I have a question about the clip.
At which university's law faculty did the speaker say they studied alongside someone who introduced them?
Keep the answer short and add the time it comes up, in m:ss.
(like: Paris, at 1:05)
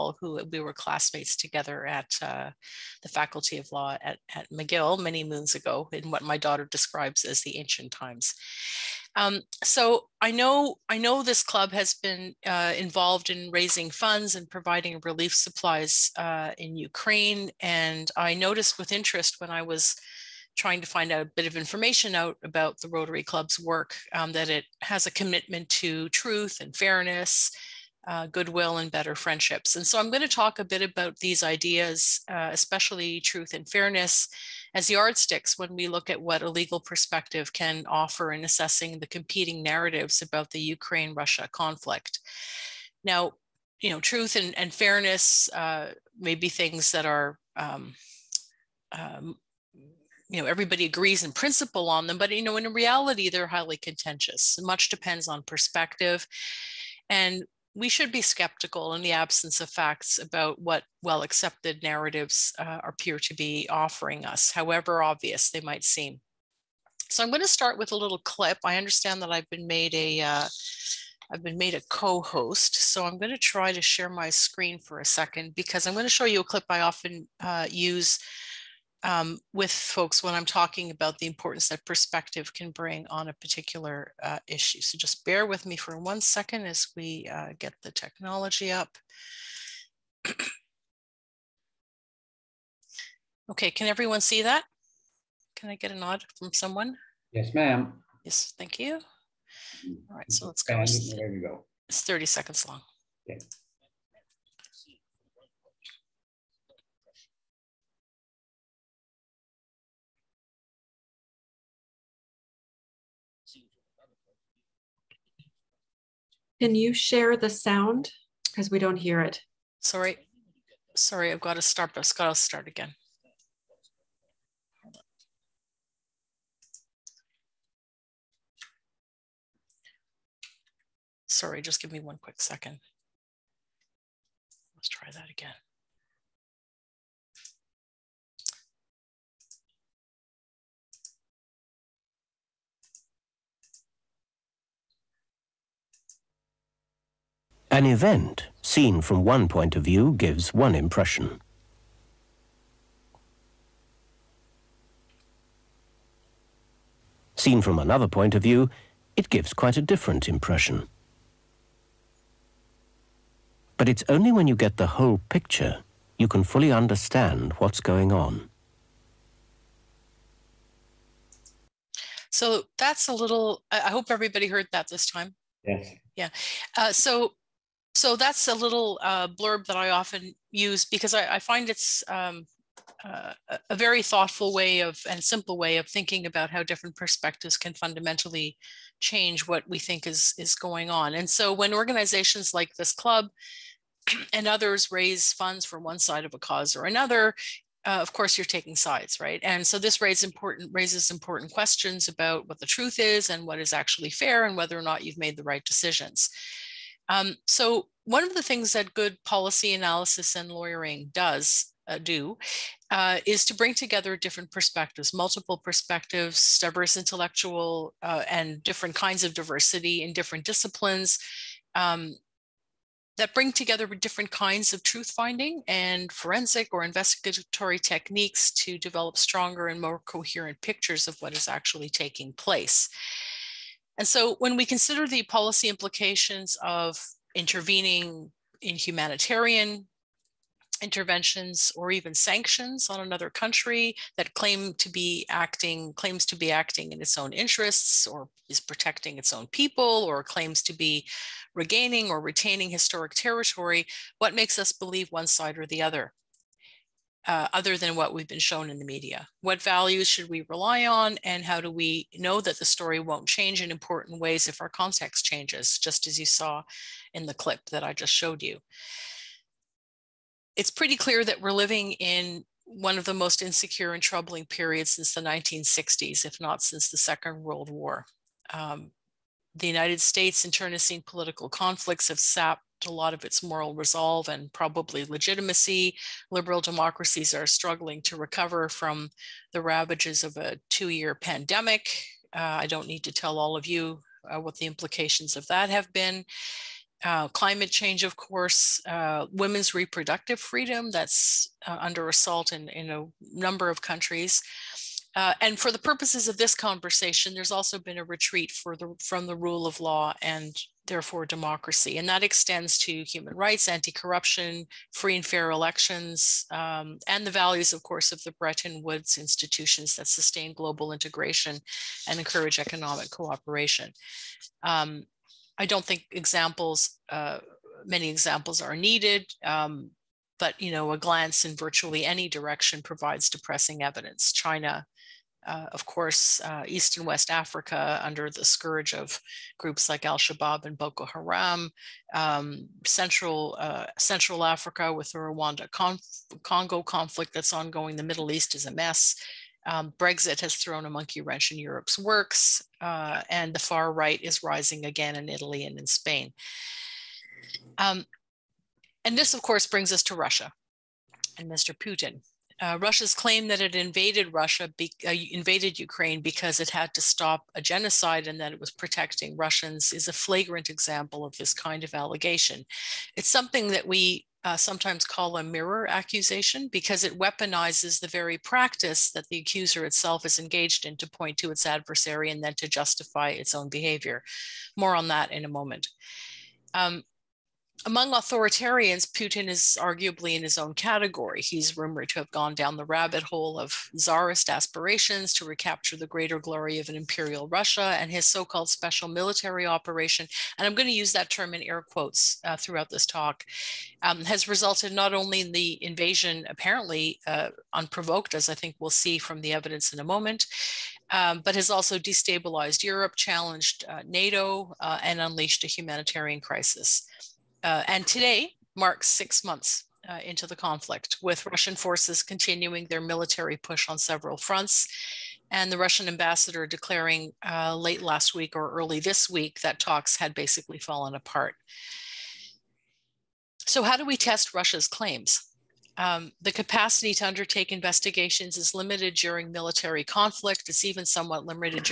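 McGill, at 0:04.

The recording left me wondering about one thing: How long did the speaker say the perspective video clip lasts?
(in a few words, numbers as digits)
30 seconds.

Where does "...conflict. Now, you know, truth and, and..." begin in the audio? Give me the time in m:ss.
0:41.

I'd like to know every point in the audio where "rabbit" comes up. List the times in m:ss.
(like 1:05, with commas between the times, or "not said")
6:32.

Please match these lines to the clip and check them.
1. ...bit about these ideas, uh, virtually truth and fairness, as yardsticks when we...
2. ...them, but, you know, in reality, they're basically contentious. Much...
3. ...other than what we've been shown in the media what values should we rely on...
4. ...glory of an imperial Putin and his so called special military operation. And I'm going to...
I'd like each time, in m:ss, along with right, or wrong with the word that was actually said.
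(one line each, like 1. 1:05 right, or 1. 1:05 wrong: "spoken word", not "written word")
1. 0:30 wrong: "especially", not "virtually"
2. 0:52 wrong: "highly", not "basically"
3. 4:17 right
4. 6:36 wrong: "Russia", not "Putin".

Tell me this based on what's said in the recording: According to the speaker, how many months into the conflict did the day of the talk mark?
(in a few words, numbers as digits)
6.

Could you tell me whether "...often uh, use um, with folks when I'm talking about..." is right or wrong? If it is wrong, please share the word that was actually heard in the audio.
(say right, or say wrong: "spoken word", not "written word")
right.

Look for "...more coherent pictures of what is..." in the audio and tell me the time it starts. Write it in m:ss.
3:49.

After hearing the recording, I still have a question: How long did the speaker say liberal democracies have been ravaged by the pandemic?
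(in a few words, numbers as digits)
2 years.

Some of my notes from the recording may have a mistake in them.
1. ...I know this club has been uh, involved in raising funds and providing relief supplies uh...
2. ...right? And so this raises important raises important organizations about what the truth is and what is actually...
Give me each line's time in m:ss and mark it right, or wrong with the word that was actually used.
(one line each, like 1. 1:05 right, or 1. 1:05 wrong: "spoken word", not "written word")
1. 0:10 right
2. 3:19 wrong: "questions", not "organizations".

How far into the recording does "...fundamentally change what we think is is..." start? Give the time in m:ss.
3:07.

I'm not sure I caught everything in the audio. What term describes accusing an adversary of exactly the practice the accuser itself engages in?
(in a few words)
mirror accusation.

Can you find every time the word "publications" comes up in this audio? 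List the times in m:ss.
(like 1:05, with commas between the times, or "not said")
not said.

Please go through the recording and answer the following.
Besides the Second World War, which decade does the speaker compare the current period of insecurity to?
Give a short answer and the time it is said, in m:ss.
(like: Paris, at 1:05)
1960s, at 4:35.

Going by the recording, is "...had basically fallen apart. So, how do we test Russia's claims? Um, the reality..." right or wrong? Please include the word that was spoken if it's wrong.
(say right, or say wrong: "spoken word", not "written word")
wrong: "capacity", not "reality".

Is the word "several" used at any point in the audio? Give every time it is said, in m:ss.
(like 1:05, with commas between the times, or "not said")
7:03.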